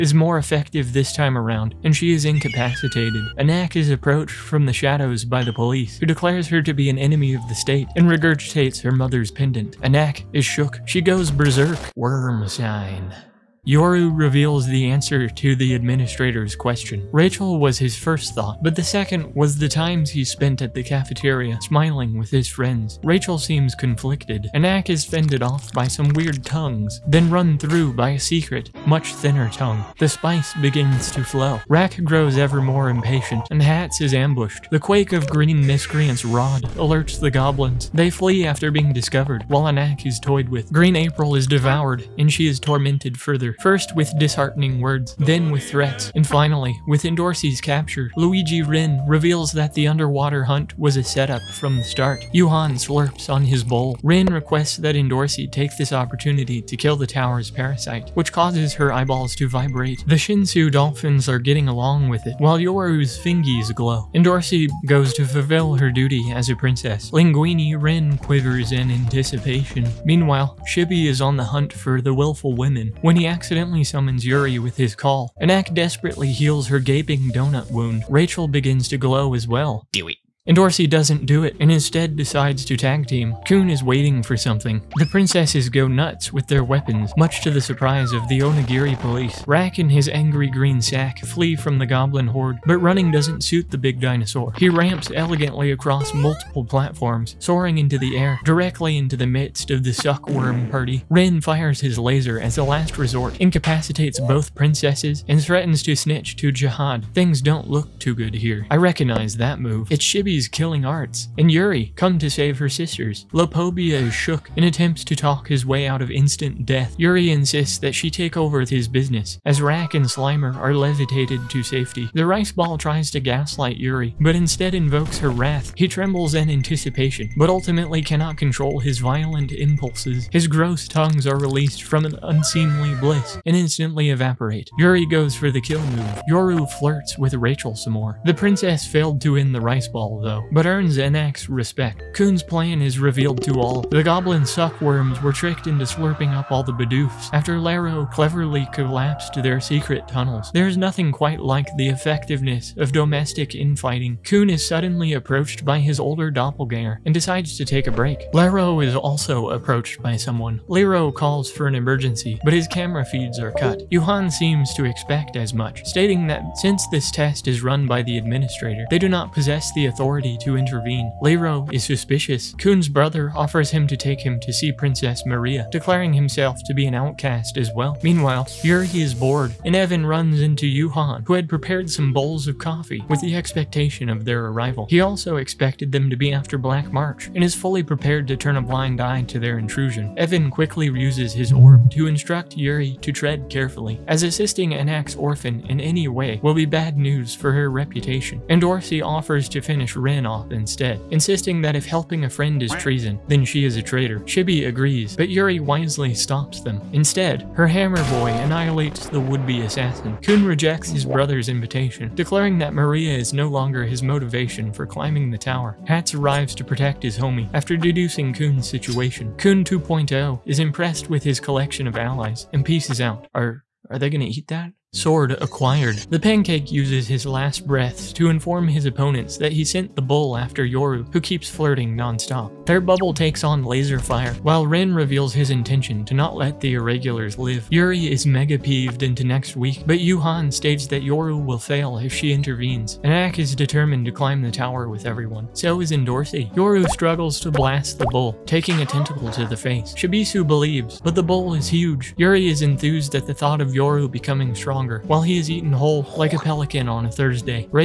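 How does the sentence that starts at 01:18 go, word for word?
Rachel begins to glow as well.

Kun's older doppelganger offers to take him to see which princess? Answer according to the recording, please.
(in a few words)
Princess Maria.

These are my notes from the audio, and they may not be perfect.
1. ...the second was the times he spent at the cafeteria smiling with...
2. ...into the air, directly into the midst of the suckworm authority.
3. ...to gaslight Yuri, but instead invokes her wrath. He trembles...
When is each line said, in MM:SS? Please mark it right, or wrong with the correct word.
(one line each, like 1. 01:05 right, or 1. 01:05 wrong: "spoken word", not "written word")
1. 00:18 right
2. 01:37 wrong: "party", not "authority"
3. 02:03 right.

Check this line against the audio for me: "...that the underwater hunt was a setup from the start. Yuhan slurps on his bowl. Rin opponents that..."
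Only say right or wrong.
wrong.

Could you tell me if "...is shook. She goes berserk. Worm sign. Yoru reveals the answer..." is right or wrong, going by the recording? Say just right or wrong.
right.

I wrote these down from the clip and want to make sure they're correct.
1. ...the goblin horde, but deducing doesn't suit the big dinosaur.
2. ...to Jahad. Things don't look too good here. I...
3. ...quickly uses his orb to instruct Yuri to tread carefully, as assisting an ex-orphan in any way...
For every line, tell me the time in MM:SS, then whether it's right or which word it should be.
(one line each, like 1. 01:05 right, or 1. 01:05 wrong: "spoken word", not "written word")
1. 01:31 wrong: "running", not "deducing"
2. 01:46 right
3. 03:10 right.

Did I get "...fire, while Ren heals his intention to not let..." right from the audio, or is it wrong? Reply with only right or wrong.
wrong.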